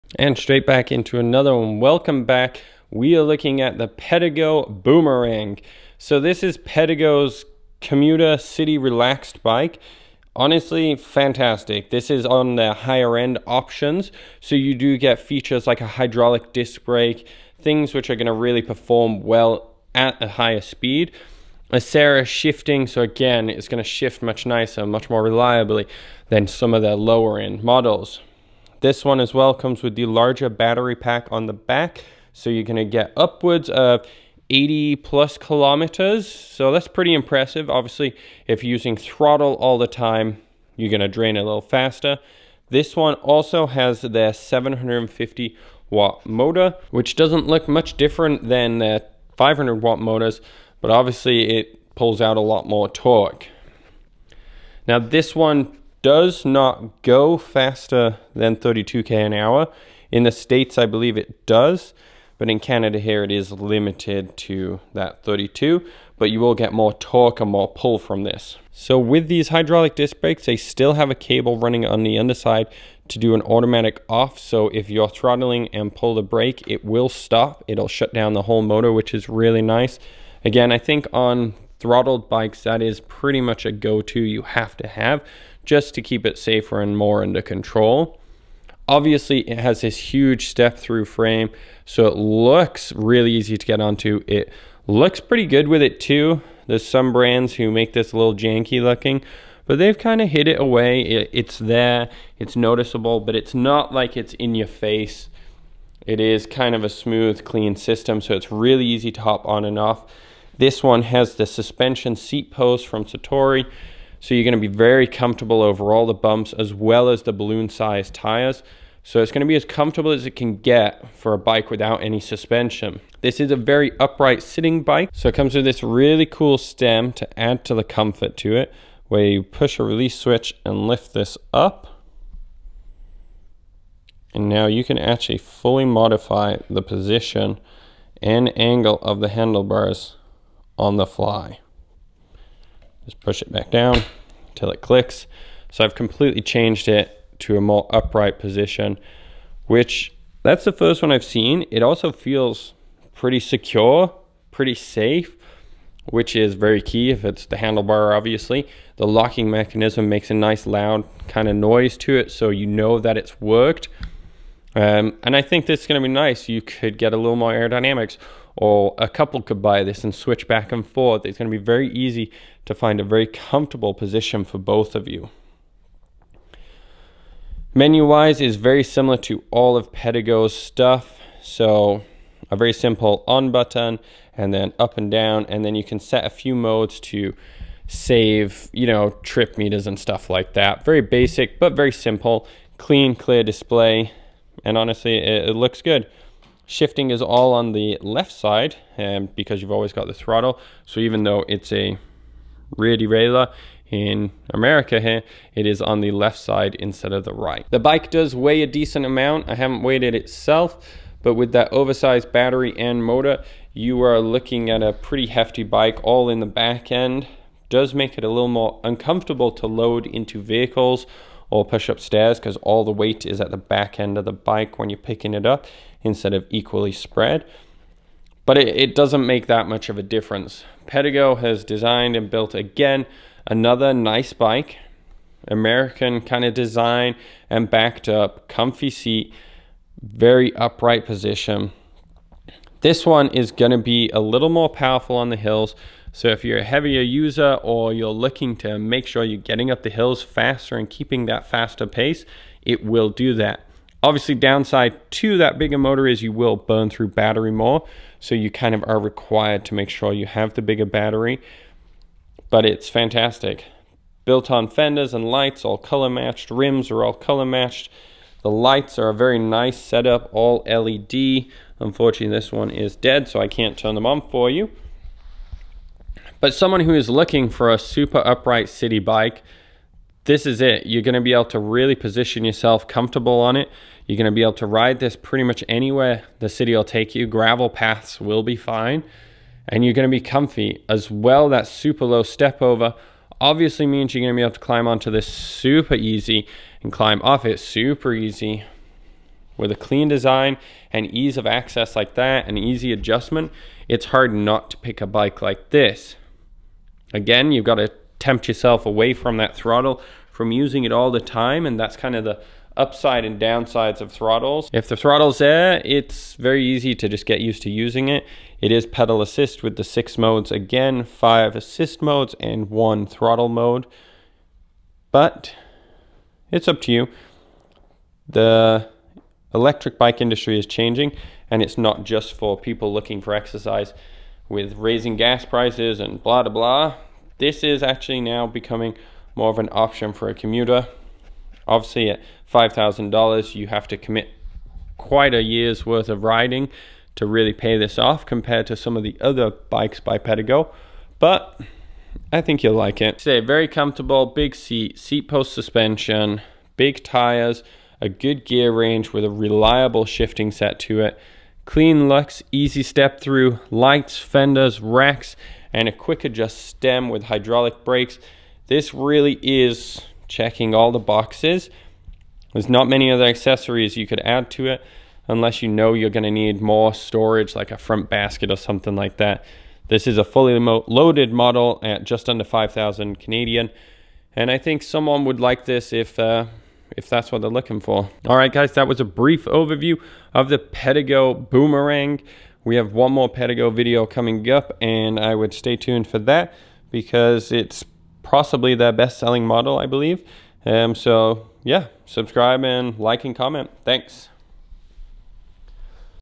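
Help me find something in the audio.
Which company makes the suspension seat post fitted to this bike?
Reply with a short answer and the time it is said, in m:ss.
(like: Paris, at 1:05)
Satori, at 1:53.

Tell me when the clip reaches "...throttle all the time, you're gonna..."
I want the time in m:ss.
0:38.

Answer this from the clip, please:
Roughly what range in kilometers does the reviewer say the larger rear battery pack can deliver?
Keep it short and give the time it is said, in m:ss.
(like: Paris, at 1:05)
80, at 0:34.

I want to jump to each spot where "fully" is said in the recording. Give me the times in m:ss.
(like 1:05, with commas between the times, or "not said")
2:15, 6:20.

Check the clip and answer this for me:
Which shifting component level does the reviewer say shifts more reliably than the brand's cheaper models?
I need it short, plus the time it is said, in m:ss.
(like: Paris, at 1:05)
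Acera, at 0:21.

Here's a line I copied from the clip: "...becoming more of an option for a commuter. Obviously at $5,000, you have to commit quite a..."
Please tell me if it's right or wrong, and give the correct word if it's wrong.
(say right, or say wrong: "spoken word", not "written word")
right.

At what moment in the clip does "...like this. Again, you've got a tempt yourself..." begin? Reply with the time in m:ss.
5:05.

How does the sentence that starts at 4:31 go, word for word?
Unfortunately, this one is dead, so I can't turn them on for you.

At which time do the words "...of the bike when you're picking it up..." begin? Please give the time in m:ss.
3:44.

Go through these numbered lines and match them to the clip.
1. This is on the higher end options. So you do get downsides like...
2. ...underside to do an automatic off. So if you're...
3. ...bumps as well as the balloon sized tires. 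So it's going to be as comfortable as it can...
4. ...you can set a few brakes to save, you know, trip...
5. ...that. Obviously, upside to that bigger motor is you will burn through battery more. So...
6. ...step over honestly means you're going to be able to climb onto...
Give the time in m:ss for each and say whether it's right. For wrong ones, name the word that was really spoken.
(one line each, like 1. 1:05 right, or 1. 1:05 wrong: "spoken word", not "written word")
1. 0:11 wrong: "features", not "downsides"
2. 1:12 right
3. 1:56 right
4. 3:05 wrong: "modes", not "brakes"
5. 4:13 wrong: "downside", not "upside"
6. 4:52 wrong: "obviously", not "honestly".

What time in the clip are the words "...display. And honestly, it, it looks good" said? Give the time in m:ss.
3:13.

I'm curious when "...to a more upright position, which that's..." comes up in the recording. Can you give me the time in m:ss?
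2:27.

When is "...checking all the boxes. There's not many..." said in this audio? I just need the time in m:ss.
6:10.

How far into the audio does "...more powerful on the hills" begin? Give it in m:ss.
4:04.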